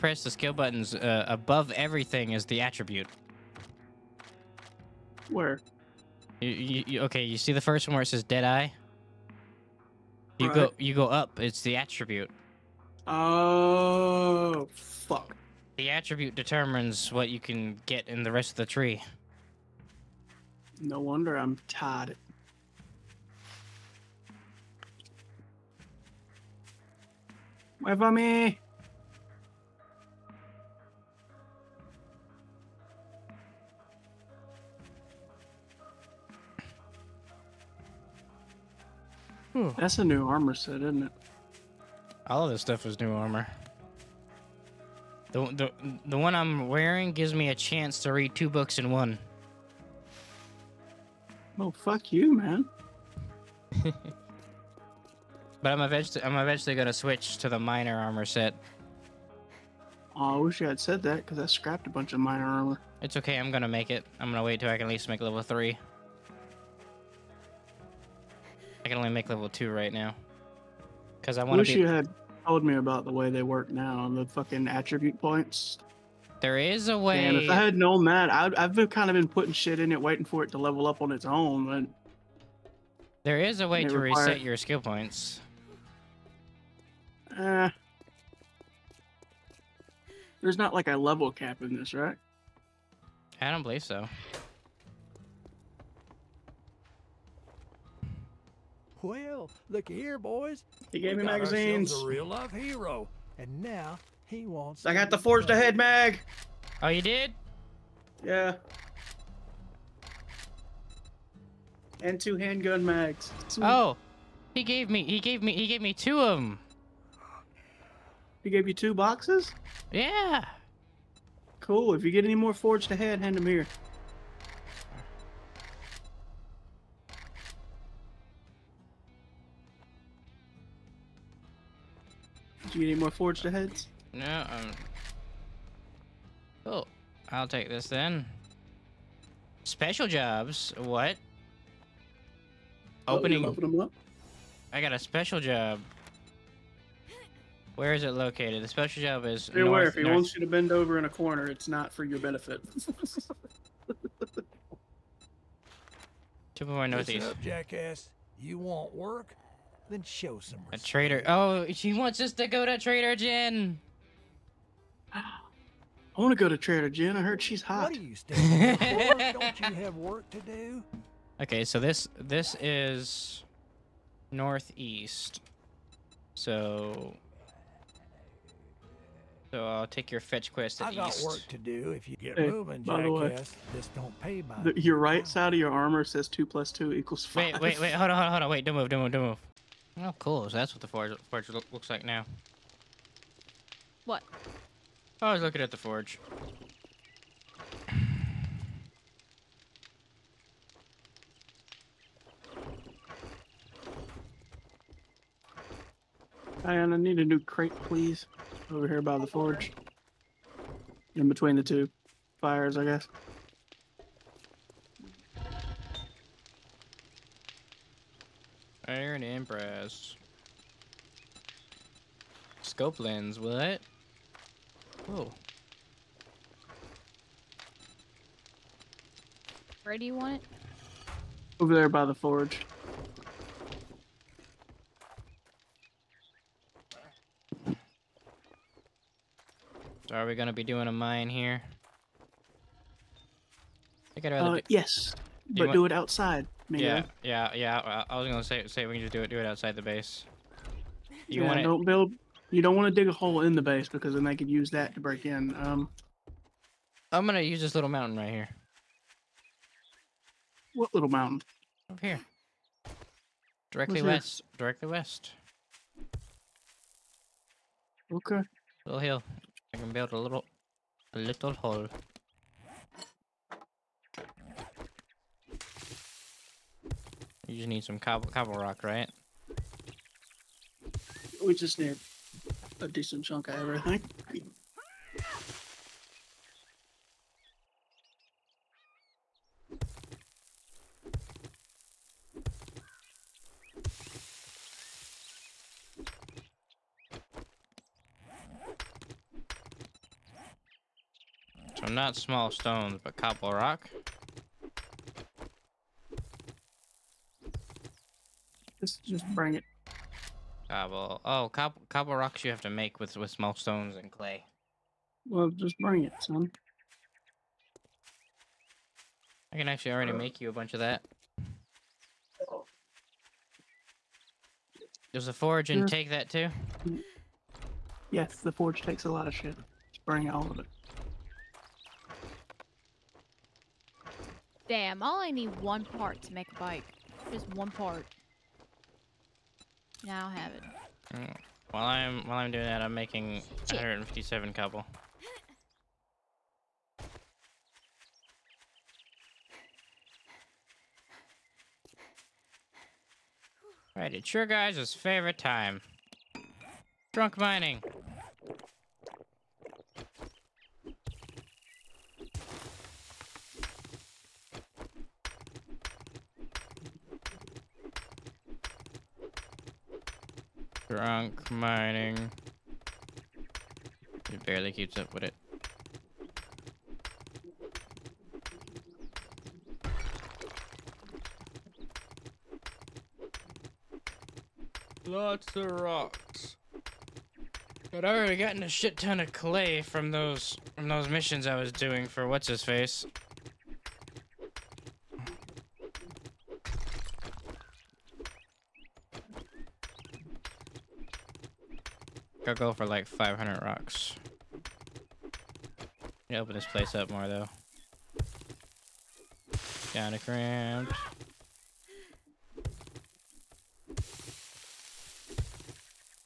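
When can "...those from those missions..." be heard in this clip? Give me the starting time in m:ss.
6:30.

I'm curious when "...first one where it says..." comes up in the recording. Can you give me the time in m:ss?
0:07.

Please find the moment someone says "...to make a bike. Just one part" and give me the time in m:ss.
5:36.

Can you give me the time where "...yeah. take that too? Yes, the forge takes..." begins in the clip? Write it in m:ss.
5:25.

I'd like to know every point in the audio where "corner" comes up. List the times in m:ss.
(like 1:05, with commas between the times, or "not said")
2:31.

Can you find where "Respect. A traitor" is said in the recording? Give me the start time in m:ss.
2:40.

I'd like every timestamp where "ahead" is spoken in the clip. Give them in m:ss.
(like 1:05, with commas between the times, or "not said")
1:45, 2:02, 2:13.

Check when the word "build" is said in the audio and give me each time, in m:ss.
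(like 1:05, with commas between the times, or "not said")
4:11, 4:29.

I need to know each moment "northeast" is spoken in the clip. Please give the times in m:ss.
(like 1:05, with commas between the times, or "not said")
2:36, 2:54.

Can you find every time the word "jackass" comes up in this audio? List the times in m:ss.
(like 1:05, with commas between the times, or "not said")
2:37.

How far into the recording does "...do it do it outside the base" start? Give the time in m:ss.
4:09.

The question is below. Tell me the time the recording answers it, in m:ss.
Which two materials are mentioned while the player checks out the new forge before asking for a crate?
3:38.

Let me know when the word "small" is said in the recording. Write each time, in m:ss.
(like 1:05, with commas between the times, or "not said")
5:02, 5:13.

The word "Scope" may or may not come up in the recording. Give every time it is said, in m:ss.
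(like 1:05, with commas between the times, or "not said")
3:42.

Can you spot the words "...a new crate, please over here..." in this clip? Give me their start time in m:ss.
3:27.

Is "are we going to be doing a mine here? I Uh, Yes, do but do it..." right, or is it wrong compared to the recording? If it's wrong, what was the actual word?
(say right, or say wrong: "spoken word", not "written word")
right.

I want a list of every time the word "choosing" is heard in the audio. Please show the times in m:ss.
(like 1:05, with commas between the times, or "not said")
not said.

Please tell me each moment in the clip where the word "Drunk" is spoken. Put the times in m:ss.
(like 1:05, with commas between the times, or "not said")
5:57, 6:10.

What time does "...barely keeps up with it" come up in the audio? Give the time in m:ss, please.
6:14.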